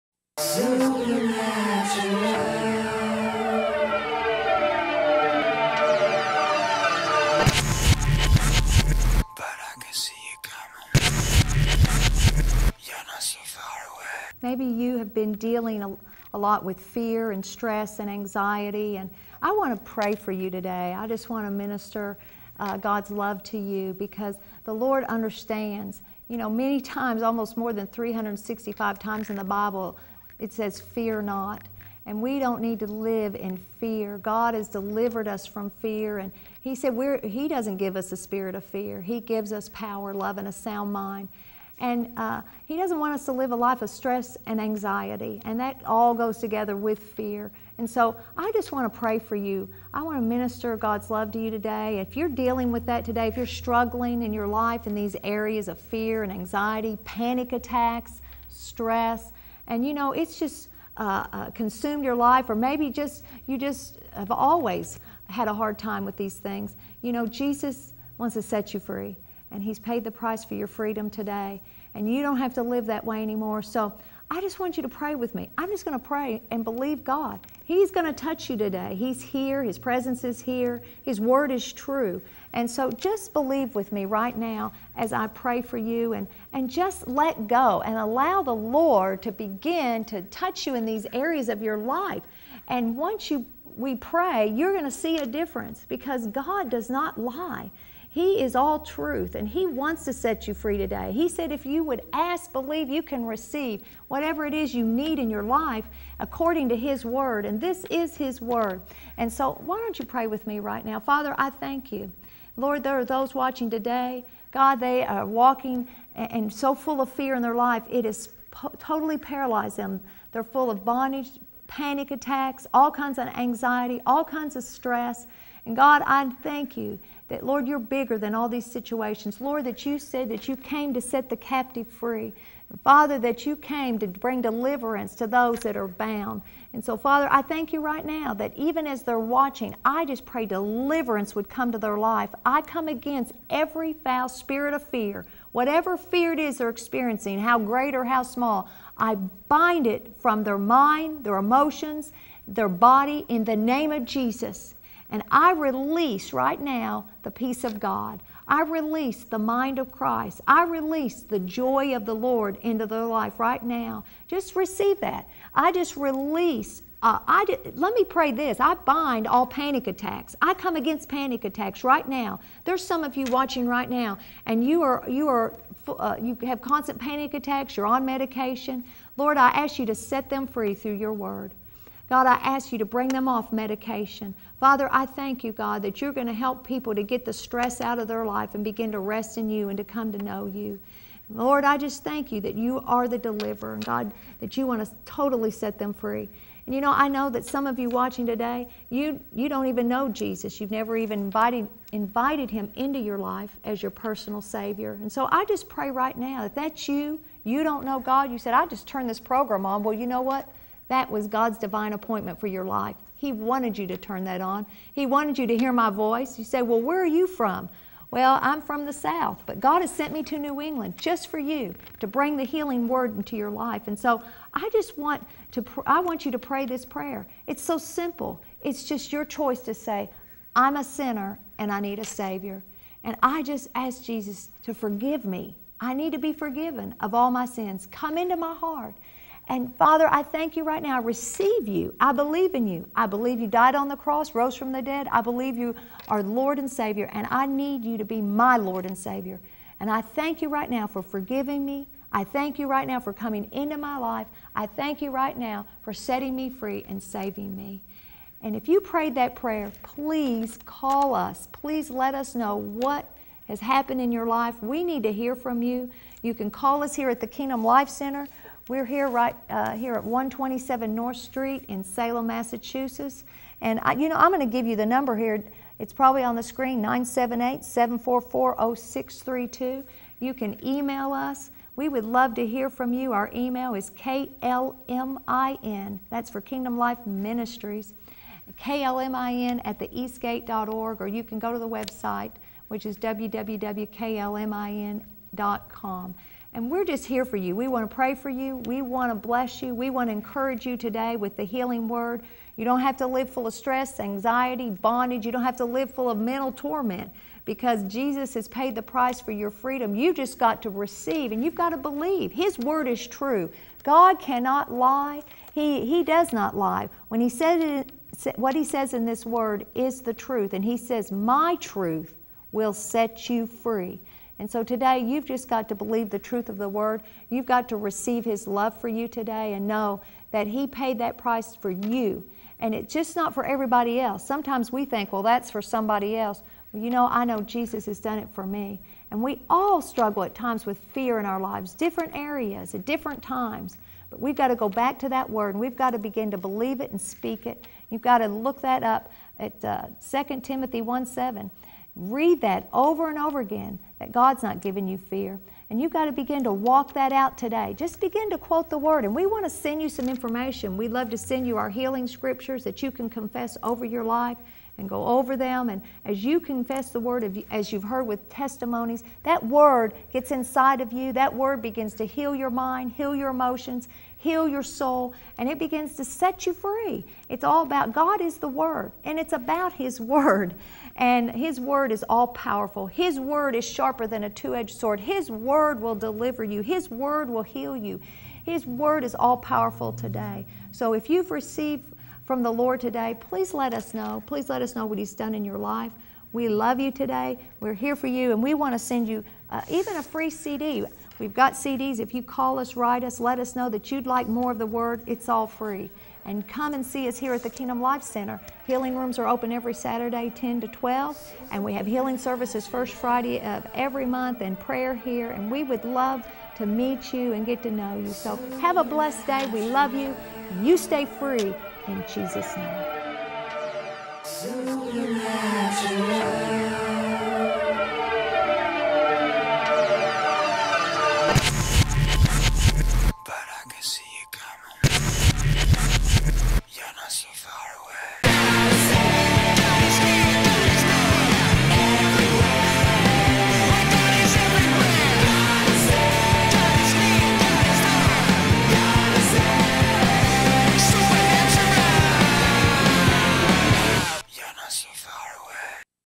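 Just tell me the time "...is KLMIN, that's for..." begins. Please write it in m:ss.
4:43.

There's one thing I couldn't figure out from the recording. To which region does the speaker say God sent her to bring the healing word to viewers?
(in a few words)
New England.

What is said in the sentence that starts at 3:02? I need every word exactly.
God, I ask you to bring them off medication.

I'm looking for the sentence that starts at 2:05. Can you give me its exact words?
And God, I thank you that, Lord, you're bigger than all these situations.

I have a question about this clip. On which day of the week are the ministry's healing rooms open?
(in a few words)
Saturday.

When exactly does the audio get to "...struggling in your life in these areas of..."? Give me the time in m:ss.
0:53.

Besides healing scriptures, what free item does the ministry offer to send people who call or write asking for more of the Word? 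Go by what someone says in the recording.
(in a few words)
a free CD.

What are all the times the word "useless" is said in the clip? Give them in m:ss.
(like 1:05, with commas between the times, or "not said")
not said.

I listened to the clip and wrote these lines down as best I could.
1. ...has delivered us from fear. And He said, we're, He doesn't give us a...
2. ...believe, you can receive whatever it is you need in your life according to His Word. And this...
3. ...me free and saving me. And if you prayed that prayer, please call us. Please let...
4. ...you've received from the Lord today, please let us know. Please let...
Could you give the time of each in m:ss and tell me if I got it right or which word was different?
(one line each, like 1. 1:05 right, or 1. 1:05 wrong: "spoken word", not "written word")
1. 0:34 right
2. 1:42 right
3. 4:16 right
4. 6:31 right.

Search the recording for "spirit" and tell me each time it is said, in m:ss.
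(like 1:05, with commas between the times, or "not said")
0:38, 2:24.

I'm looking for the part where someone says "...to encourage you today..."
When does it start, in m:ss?
5:00.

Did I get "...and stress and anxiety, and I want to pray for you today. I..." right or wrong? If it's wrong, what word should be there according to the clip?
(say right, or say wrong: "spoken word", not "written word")
right.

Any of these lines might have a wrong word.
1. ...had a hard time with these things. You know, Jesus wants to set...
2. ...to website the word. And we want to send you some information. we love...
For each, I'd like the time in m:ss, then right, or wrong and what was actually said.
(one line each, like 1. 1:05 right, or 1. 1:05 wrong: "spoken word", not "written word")
1. 1:05 right
2. 5:58 wrong: "quote", not "website".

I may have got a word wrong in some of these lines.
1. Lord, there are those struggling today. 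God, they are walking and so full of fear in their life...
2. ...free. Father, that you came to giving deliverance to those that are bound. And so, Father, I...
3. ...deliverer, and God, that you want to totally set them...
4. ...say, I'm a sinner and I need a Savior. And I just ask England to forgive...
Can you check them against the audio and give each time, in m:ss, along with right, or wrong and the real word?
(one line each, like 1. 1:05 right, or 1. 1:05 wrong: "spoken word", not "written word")
1. 1:52 wrong: "watching", not "struggling"
2. 2:11 wrong: "bring", not "giving"
3. 3:13 right
4. 3:49 wrong: "Jesus", not "England".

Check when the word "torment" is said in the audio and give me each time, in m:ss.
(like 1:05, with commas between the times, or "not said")
5:06.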